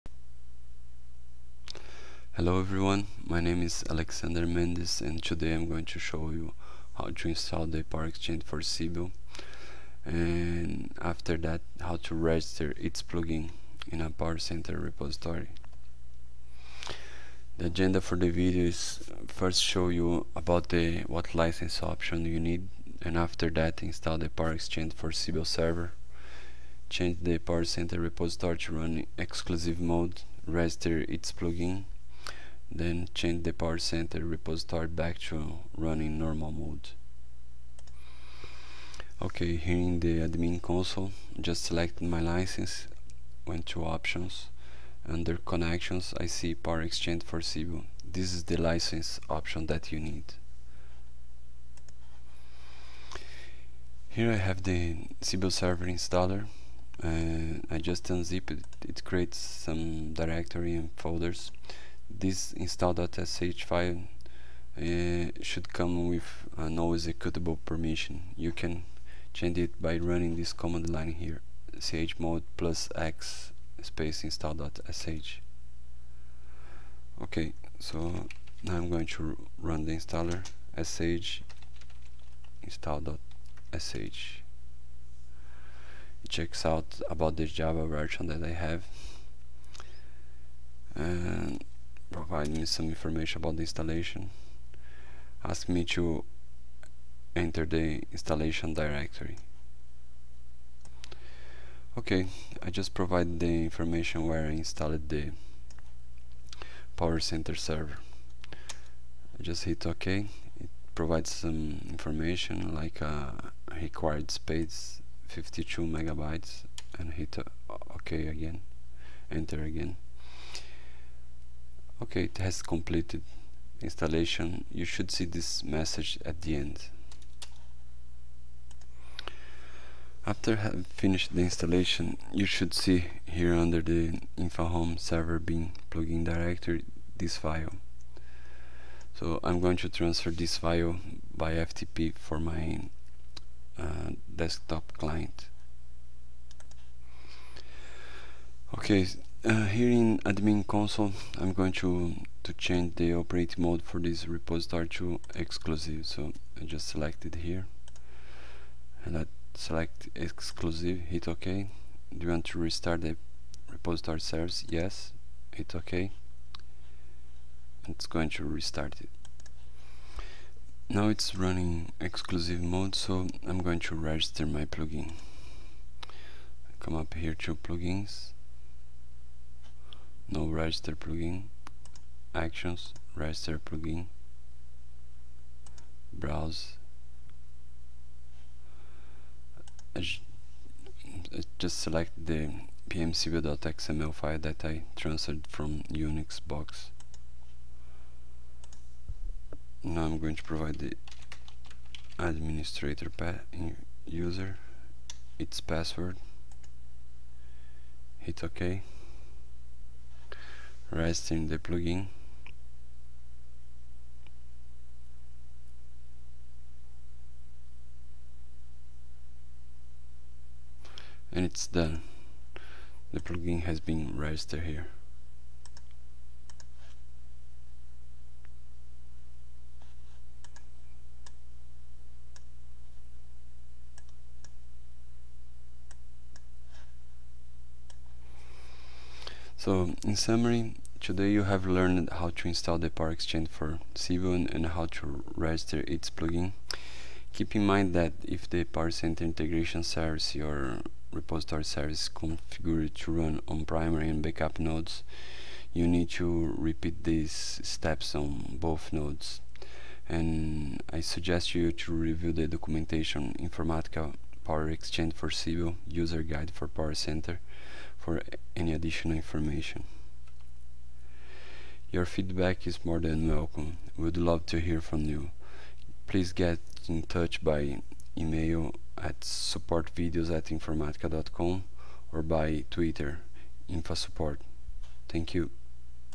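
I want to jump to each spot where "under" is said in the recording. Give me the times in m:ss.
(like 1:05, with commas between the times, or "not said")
0:45, 2:13.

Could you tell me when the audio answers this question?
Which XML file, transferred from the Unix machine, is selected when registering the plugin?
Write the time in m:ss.
3:12.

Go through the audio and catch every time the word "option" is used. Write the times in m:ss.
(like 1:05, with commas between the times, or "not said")
0:21, 0:43, 0:49.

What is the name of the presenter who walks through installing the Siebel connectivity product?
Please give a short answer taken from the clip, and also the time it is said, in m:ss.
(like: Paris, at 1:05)
Alexander Mendes, at 0:03.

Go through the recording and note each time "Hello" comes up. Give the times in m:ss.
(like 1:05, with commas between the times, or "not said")
0:02.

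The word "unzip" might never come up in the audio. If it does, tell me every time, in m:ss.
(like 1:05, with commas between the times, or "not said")
0:58.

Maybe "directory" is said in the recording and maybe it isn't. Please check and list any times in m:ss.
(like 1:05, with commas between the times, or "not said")
1:00, 1:38, 2:16.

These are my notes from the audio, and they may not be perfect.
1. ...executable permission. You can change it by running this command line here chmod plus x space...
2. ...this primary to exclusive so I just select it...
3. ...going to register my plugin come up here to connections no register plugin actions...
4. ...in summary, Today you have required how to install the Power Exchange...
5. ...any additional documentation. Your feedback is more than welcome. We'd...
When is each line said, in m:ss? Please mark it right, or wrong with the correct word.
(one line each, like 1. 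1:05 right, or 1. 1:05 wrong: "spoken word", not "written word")
1. 1:07 right
2. 2:33 wrong: "repository", not "primary"
3. 2:53 wrong: "plugins", not "connections"
4. 4:00 wrong: "learned", not "required"
5. 4:28 wrong: "information", not "documentation".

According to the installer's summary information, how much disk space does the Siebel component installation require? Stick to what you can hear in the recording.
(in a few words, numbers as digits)
52 megabytes.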